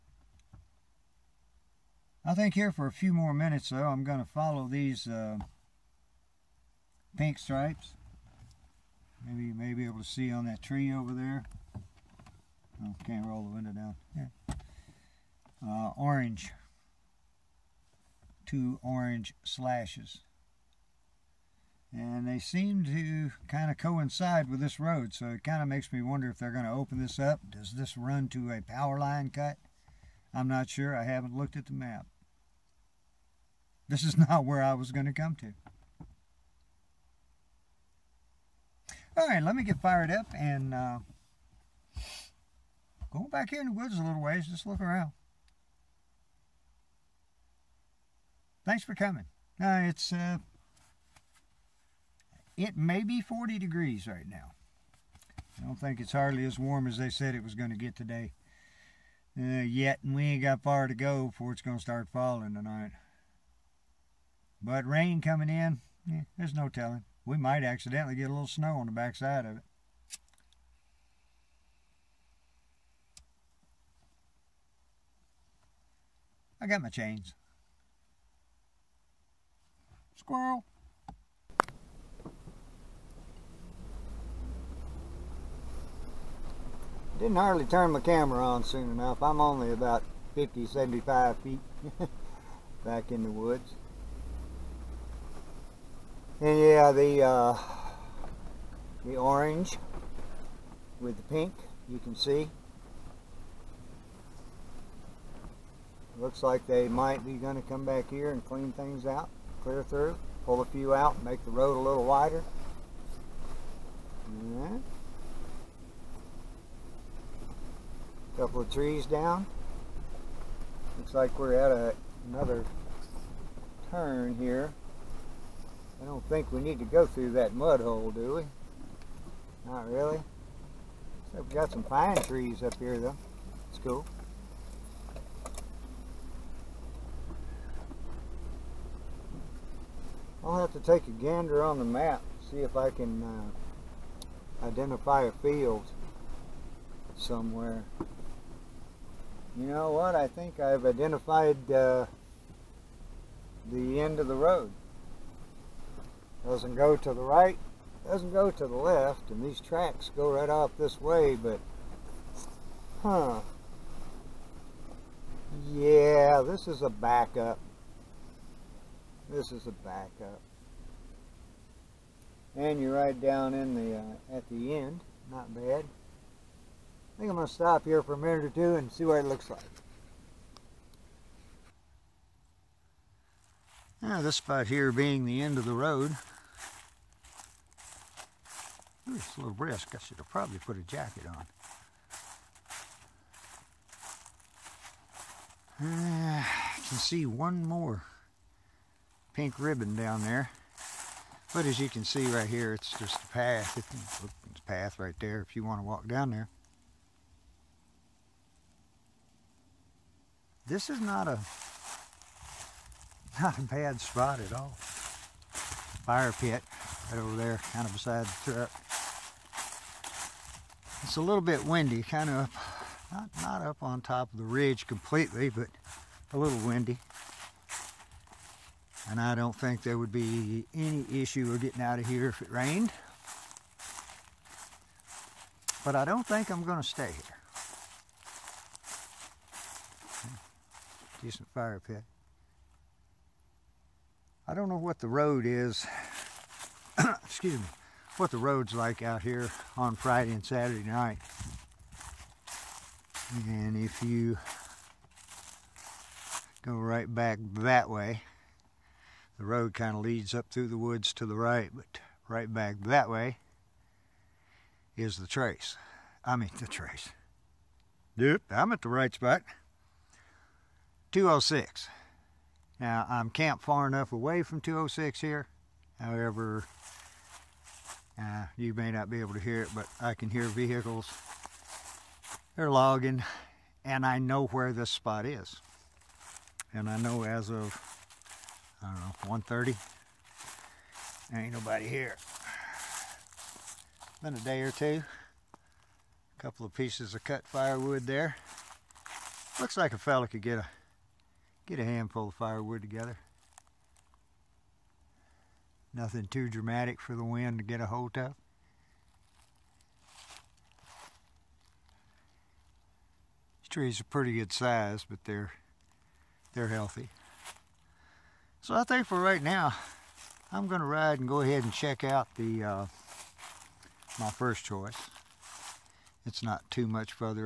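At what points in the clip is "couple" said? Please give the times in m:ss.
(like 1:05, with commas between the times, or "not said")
1:58, 4:56.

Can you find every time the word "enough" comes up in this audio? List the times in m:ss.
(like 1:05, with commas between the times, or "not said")
1:28, 4:33.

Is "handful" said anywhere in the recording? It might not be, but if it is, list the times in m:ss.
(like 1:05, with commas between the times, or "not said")
5:01.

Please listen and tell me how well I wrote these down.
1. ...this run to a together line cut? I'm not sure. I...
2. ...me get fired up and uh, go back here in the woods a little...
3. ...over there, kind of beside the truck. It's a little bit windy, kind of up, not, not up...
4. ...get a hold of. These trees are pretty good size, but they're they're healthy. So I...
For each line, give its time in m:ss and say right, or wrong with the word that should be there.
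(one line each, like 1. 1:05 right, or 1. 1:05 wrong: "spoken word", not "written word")
1. 0:27 wrong: "power", not "together"
2. 0:39 right
3. 3:37 right
4. 5:07 right.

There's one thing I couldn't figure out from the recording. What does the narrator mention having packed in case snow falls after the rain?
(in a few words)
chains.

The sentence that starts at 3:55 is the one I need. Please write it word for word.
But I don't think I'm going to stay here.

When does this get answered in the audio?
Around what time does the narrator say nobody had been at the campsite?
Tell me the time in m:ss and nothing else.
4:49.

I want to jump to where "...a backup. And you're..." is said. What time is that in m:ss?
2:49.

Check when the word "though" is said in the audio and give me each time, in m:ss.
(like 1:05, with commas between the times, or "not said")
0:03, 2:12.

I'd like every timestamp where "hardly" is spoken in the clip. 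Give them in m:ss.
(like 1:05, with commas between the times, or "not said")
0:56, 1:27.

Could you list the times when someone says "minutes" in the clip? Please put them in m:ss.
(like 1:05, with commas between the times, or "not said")
0:03, 2:58.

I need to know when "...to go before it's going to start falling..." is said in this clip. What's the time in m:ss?
1:00.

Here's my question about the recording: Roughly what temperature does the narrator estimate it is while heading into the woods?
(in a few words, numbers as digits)
40 degrees.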